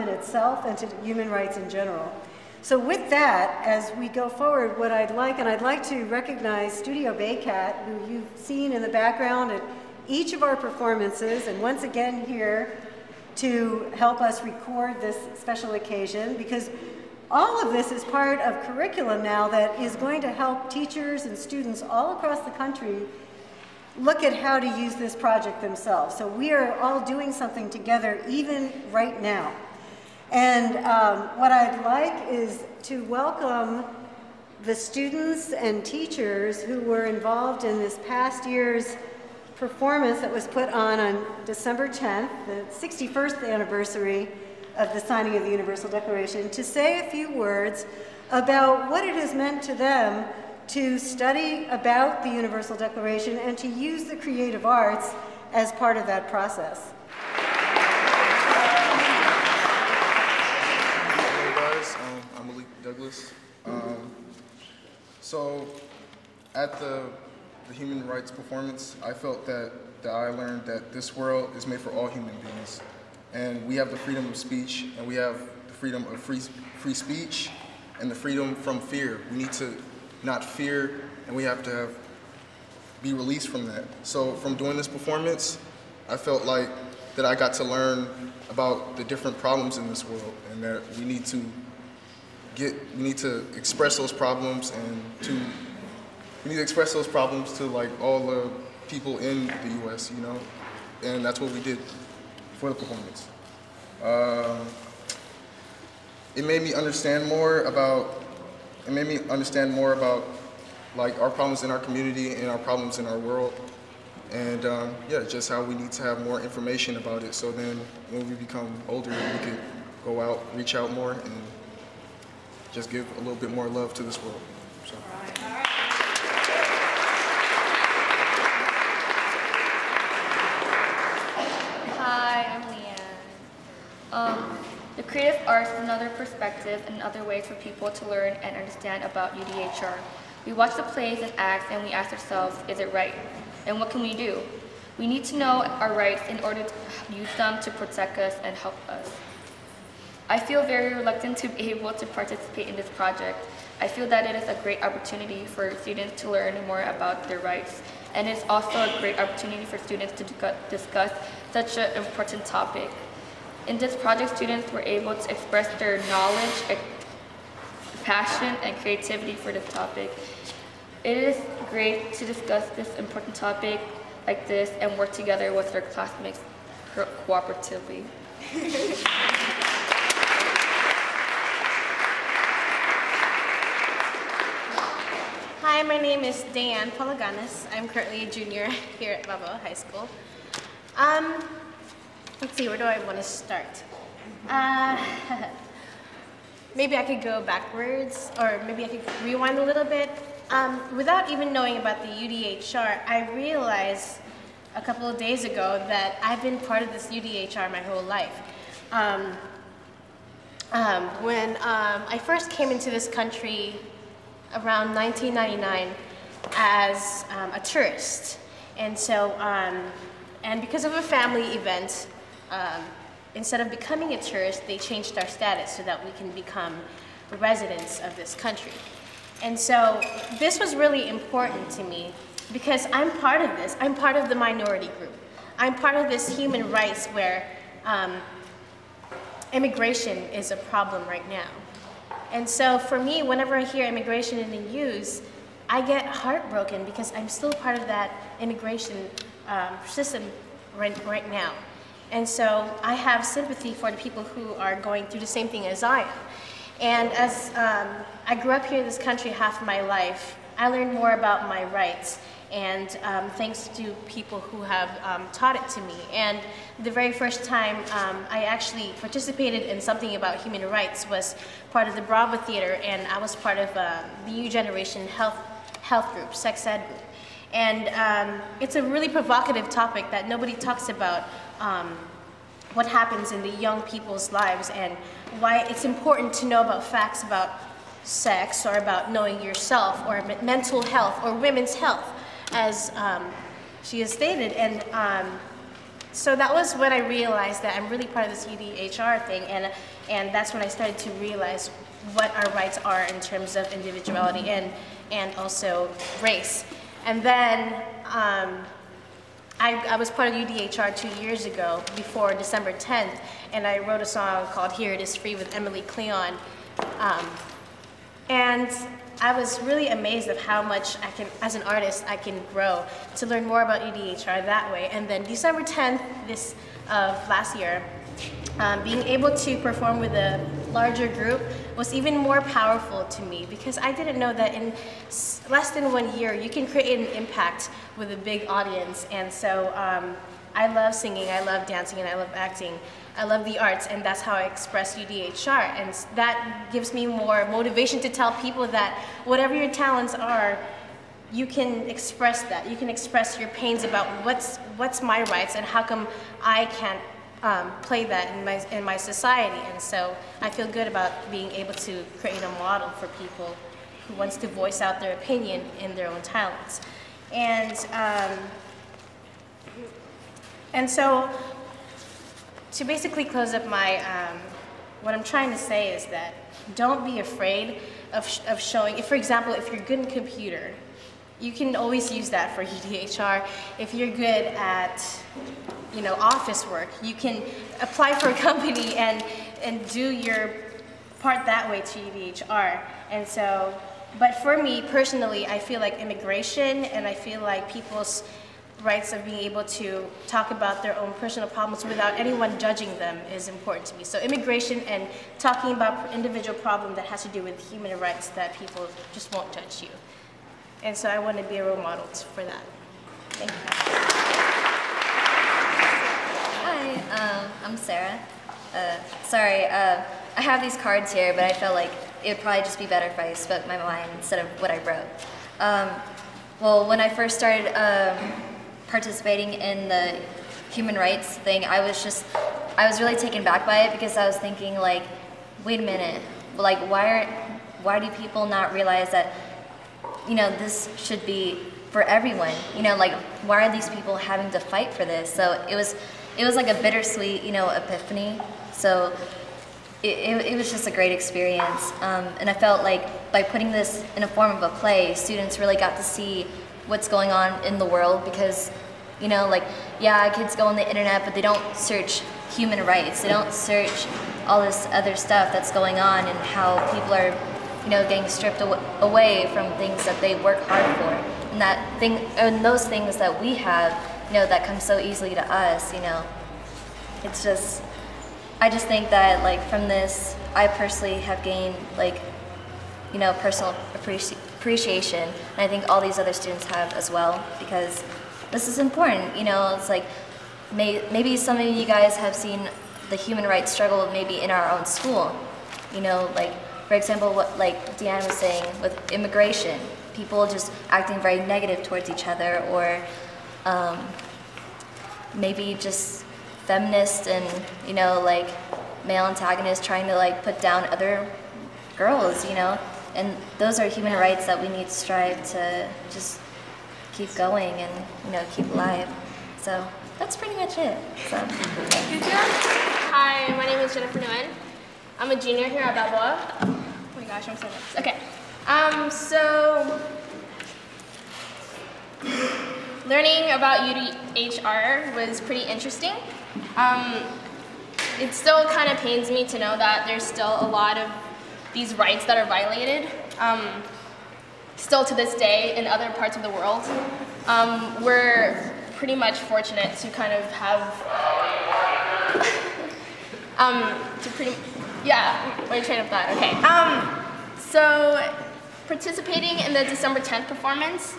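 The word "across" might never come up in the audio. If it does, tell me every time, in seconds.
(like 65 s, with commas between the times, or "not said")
22 s.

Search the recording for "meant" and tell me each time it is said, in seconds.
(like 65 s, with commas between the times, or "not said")
49 s.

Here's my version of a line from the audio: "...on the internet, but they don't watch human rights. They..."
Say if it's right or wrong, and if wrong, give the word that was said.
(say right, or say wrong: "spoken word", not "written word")
wrong: "search", not "watch".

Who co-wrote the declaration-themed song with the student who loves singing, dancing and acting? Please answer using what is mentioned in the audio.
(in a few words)
Emily Cleon.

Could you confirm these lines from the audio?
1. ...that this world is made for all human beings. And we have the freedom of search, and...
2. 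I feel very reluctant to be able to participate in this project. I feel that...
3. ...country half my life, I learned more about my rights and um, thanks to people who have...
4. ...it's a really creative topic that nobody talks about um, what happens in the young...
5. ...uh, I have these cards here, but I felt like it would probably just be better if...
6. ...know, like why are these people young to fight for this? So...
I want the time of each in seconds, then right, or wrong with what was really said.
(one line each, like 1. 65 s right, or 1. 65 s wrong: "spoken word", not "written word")
1. 70 s wrong: "speech", not "search"
2. 150 s right
3. 258 s right
4. 278 s wrong: "provocative", not "creative"
5. 419 s right
6. 442 s wrong: "having", not "young".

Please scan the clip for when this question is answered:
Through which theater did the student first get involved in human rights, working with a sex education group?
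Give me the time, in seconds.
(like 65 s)
272 s.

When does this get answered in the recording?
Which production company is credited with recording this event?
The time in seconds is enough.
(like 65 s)
6 s.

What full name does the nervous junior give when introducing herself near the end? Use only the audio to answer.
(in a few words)
Jennifer Nguyen.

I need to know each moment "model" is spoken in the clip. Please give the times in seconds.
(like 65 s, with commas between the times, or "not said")
362 s, 411 s.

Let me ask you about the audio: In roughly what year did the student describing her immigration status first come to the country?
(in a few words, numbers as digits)
1999.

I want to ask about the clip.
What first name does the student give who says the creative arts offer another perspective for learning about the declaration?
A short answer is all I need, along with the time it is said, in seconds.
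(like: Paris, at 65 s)
Leanne, at 132 s.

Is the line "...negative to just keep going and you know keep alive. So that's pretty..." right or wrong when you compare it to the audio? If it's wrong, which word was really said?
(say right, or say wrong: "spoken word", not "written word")
wrong: "strive", not "negative".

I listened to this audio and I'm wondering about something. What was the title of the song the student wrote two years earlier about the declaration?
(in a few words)
Here It Is Free.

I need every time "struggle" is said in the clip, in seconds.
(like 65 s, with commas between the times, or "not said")
493 s.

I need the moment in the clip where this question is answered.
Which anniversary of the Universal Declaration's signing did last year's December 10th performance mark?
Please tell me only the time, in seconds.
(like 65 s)
42 s.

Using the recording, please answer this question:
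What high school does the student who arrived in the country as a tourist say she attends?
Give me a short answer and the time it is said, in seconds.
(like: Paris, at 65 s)
Balboa High School, at 189 s.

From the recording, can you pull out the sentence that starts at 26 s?
So we are all doing something together even right now.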